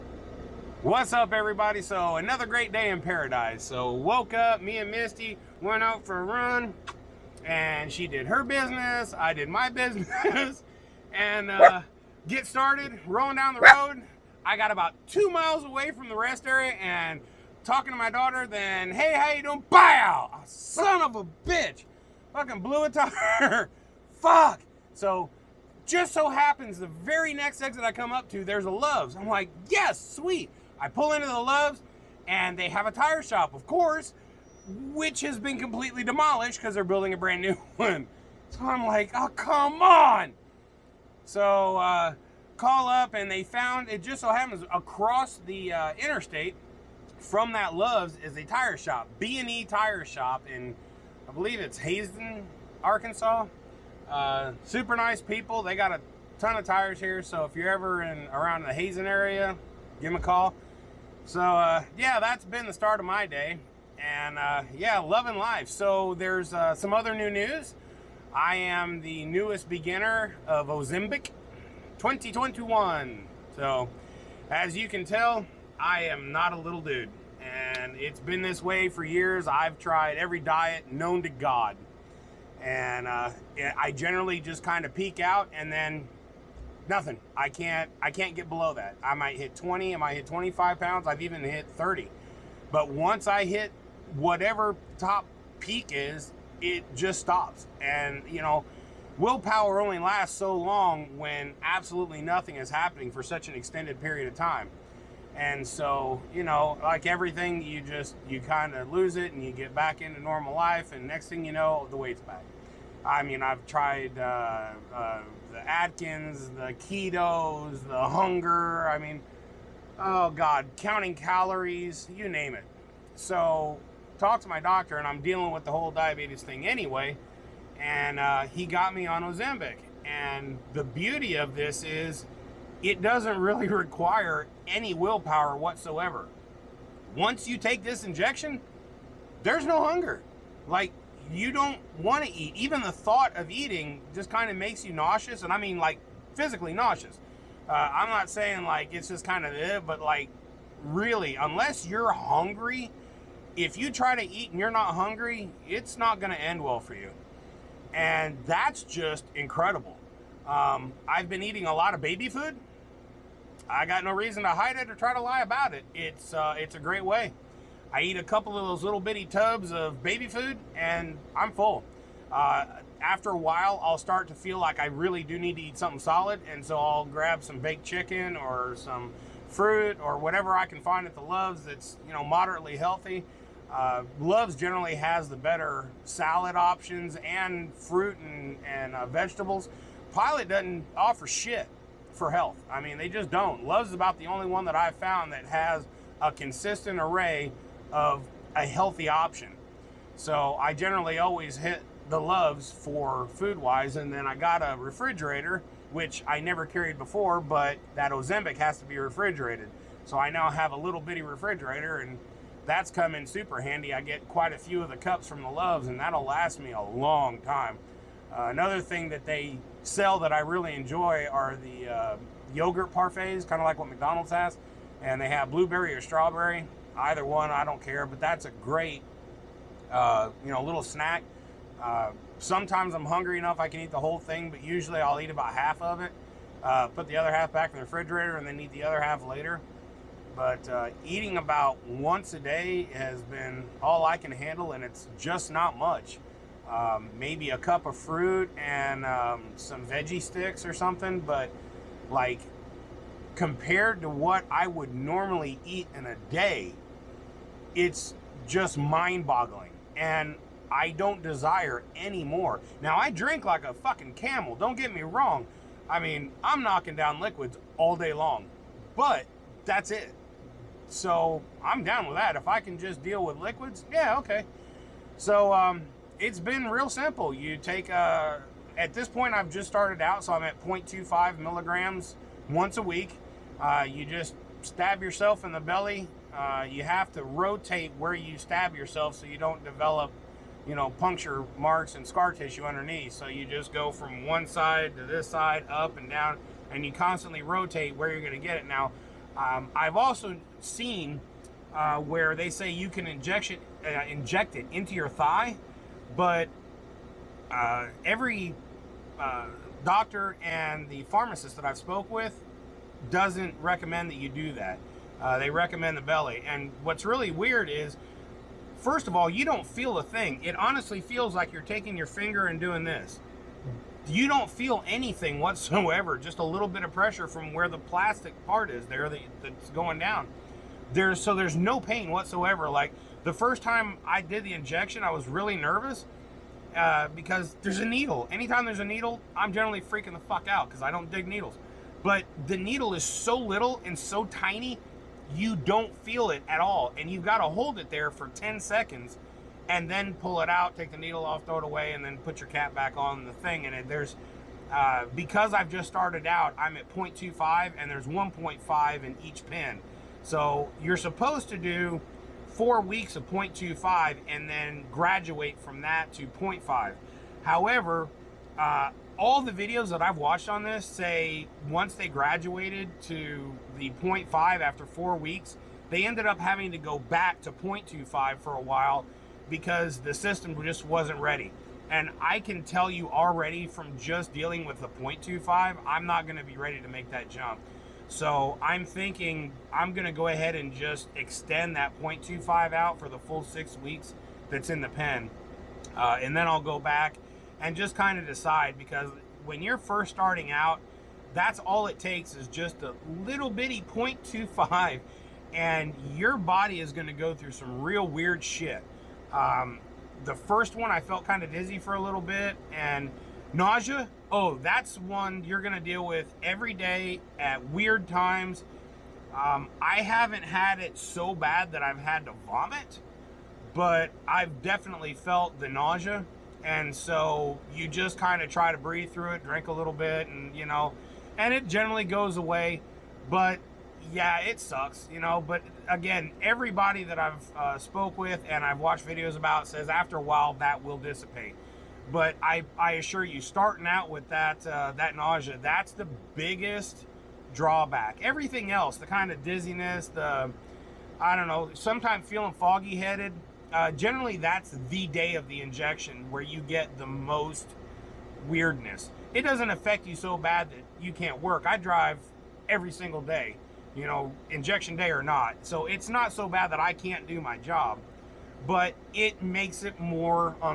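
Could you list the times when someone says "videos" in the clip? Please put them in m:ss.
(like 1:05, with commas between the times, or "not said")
6:09, 7:19.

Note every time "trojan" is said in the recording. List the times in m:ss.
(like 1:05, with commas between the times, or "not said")
not said.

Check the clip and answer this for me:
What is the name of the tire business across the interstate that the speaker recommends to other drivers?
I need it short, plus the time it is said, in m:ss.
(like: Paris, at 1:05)
B&E Tire Shop, at 0:49.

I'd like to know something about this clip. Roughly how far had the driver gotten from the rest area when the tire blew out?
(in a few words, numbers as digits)
2 miles.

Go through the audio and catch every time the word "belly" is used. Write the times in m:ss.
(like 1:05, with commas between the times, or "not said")
4:45, 5:16.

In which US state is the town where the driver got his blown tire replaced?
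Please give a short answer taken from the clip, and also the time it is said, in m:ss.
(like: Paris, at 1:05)
Arkansas, at 0:52.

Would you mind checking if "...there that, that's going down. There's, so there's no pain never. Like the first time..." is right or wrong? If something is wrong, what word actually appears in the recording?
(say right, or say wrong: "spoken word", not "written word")
wrong: "whatsoever", not "never".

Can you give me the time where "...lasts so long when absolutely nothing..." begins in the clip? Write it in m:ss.
1:39.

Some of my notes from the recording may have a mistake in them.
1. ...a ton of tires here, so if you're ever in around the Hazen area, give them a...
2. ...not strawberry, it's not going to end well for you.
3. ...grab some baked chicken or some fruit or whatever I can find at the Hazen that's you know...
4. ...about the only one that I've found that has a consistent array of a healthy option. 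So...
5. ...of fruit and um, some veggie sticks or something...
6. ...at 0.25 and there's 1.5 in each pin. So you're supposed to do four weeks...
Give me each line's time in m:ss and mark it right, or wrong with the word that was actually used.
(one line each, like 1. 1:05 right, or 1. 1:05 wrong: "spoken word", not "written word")
1. 0:55 right
2. 2:34 wrong: "hungry", not "strawberry"
3. 2:57 wrong: "Loves", not "Hazen"
4. 3:13 right
5. 4:07 right
6. 5:56 right.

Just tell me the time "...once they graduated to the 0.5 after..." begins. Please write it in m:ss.
6:11.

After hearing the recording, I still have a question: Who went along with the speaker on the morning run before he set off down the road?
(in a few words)
Misty.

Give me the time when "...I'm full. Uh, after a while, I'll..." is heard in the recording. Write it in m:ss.
2:51.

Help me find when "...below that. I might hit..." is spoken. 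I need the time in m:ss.
1:28.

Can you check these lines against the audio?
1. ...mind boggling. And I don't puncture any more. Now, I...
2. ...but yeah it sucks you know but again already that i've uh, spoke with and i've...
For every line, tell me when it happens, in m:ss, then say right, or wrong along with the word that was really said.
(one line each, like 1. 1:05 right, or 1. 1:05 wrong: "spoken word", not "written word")
1. 4:18 wrong: "desire", not "puncture"
2. 7:13 wrong: "everybody", not "already".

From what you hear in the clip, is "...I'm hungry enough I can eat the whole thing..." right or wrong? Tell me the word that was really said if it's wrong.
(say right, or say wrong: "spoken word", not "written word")
right.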